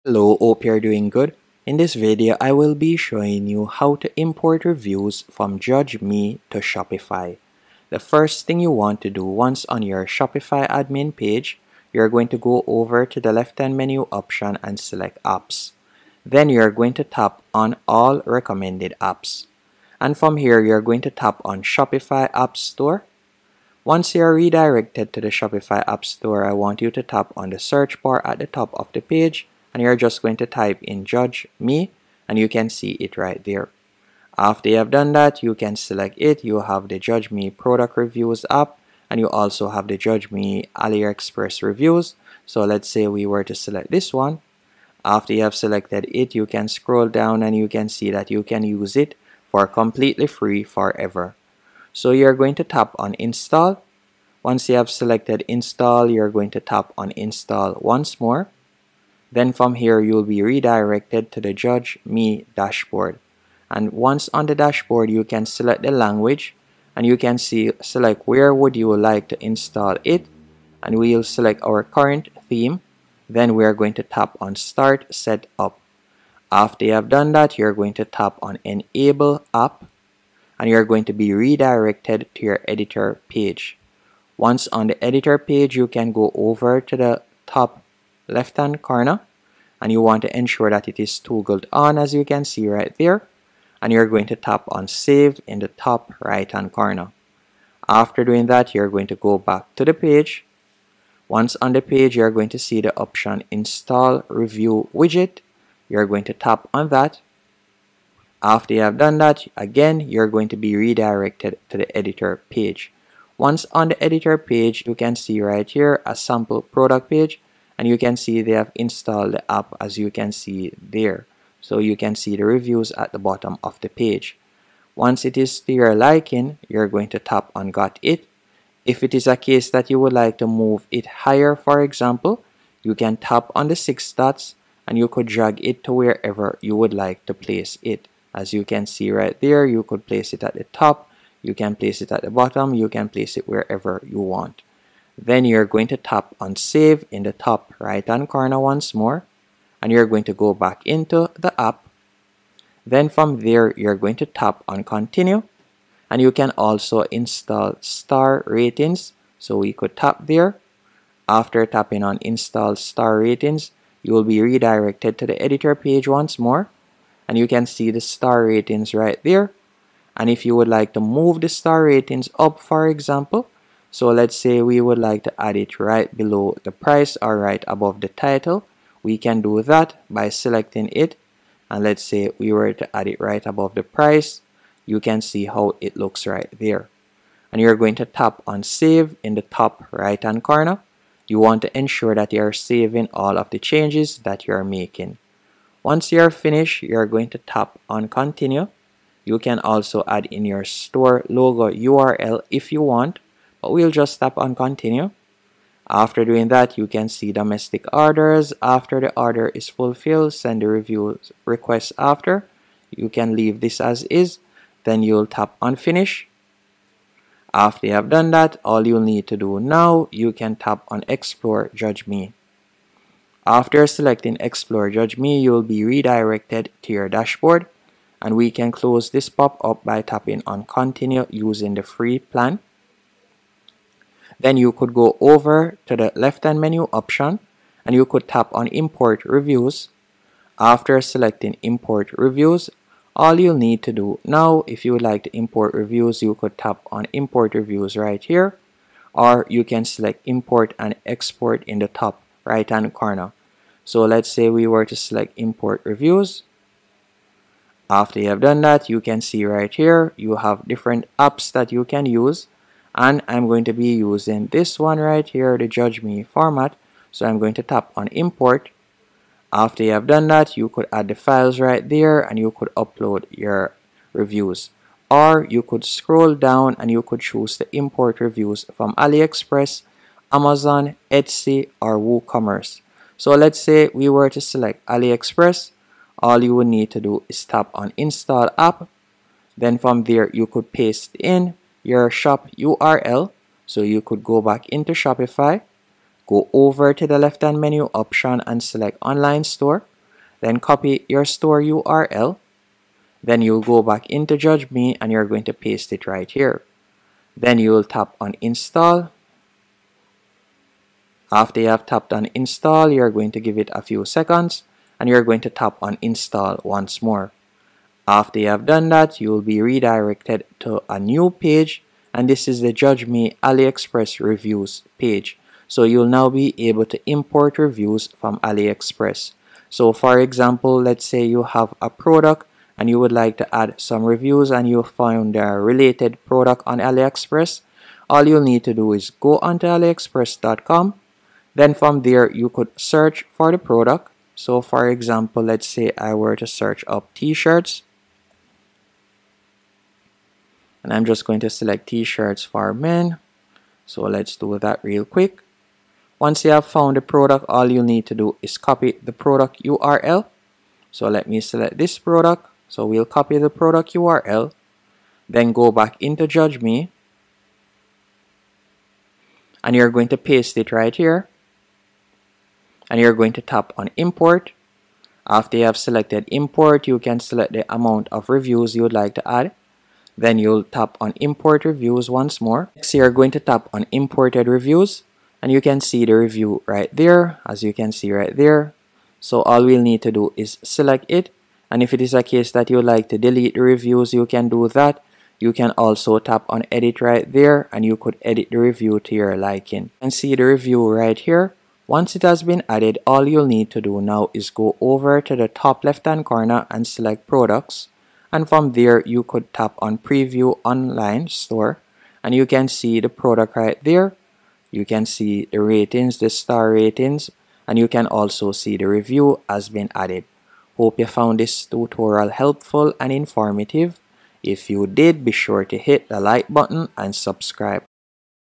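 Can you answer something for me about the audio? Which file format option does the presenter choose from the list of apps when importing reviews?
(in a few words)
Judge Me format.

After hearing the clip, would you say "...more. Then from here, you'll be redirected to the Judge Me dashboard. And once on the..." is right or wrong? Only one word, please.
right.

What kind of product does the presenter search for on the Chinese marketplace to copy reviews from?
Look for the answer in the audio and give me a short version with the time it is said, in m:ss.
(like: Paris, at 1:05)
t-shirts for men, at 5:51.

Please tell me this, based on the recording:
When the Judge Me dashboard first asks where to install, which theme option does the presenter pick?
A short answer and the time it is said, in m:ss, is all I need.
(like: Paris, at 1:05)
current theme, at 1:11.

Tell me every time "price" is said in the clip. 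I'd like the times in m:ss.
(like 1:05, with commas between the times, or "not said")
2:56, 3:03.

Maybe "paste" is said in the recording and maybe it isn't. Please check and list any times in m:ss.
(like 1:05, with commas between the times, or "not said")
4:50, 5:05, 6:10.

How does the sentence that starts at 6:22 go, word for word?
Next, you're going to tap on imported reviews and you can see the review right there as you can see right there.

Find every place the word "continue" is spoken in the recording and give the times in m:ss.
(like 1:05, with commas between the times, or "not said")
2:34, 3:18, 3:24, 3:50.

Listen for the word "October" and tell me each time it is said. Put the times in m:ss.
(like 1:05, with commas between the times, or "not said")
not said.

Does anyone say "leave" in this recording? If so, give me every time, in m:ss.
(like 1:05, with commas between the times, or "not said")
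3:33.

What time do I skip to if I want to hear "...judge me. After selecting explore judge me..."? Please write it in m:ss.
3:41.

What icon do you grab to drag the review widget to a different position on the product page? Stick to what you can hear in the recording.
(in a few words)
six dots.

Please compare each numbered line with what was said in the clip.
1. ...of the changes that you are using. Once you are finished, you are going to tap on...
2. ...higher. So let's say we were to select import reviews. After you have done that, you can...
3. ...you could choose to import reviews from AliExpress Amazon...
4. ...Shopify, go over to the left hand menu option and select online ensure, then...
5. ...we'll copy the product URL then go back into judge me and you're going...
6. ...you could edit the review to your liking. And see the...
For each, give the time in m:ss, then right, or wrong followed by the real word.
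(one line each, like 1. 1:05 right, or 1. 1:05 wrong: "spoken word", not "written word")
1. 3:13 wrong: "making", not "using"
2. 4:12 wrong: "corner", not "higher"
3. 4:36 right
4. 4:54 wrong: "store", not "ensure"
5. 6:02 right
6. 6:37 right.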